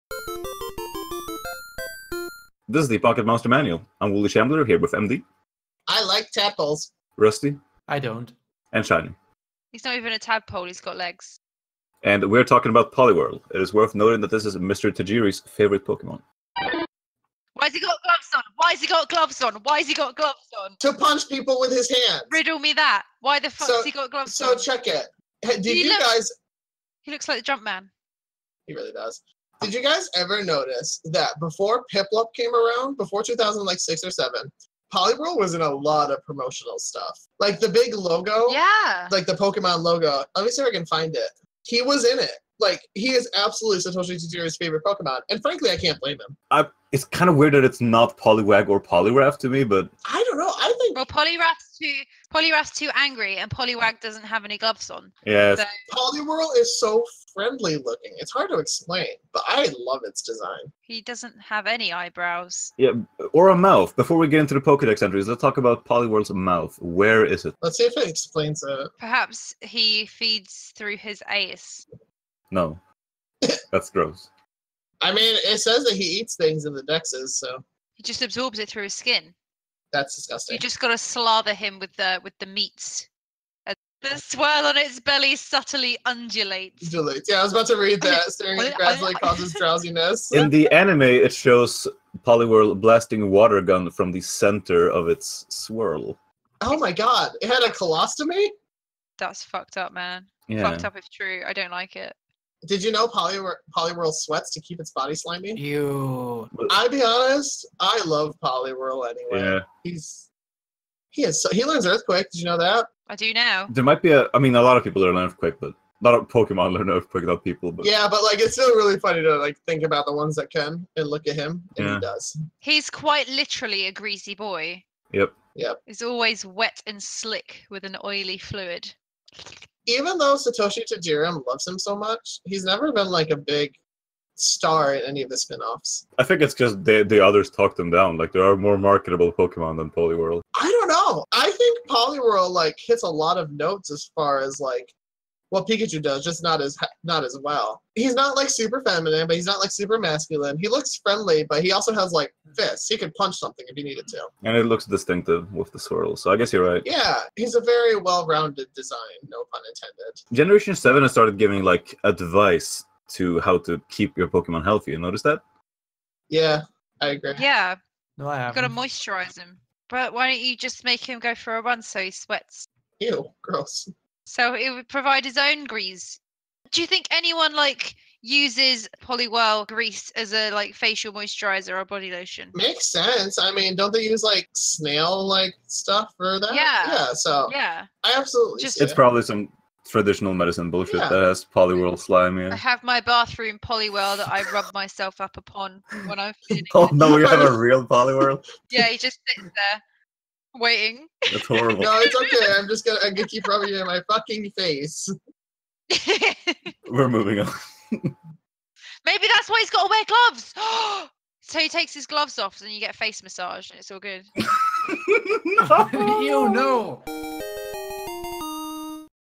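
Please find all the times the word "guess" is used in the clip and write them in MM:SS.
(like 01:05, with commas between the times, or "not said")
02:36.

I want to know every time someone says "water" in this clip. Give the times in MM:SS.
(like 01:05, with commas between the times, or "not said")
01:33.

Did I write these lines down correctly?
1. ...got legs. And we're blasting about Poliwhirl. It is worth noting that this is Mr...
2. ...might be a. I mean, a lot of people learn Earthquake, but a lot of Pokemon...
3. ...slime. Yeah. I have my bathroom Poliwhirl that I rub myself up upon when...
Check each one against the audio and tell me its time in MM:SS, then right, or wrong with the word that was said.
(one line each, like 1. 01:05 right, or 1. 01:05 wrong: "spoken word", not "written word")
1. 00:10 wrong: "talking", not "blasting"
2. 01:53 right
3. 03:11 right.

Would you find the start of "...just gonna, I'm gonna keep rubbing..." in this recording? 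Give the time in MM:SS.
03:22.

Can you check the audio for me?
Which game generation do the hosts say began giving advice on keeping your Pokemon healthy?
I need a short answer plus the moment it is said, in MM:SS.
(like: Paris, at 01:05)
Generation 7, at 02:40.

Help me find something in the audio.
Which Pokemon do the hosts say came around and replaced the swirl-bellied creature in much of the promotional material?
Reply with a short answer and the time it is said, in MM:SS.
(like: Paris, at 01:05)
Piplup, at 00:31.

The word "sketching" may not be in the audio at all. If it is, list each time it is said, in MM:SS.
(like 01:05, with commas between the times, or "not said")
not said.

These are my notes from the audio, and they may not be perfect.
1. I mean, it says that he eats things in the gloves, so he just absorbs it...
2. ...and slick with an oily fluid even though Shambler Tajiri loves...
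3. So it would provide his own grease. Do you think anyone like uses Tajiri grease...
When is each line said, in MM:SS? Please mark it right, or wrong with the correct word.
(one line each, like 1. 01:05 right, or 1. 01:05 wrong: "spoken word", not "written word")
1. 01:15 wrong: "dexes", not "gloves"
2. 02:06 wrong: "Satoshi", not "Shambler"
3. 02:54 wrong: "Poliwhirl", not "Tajiri".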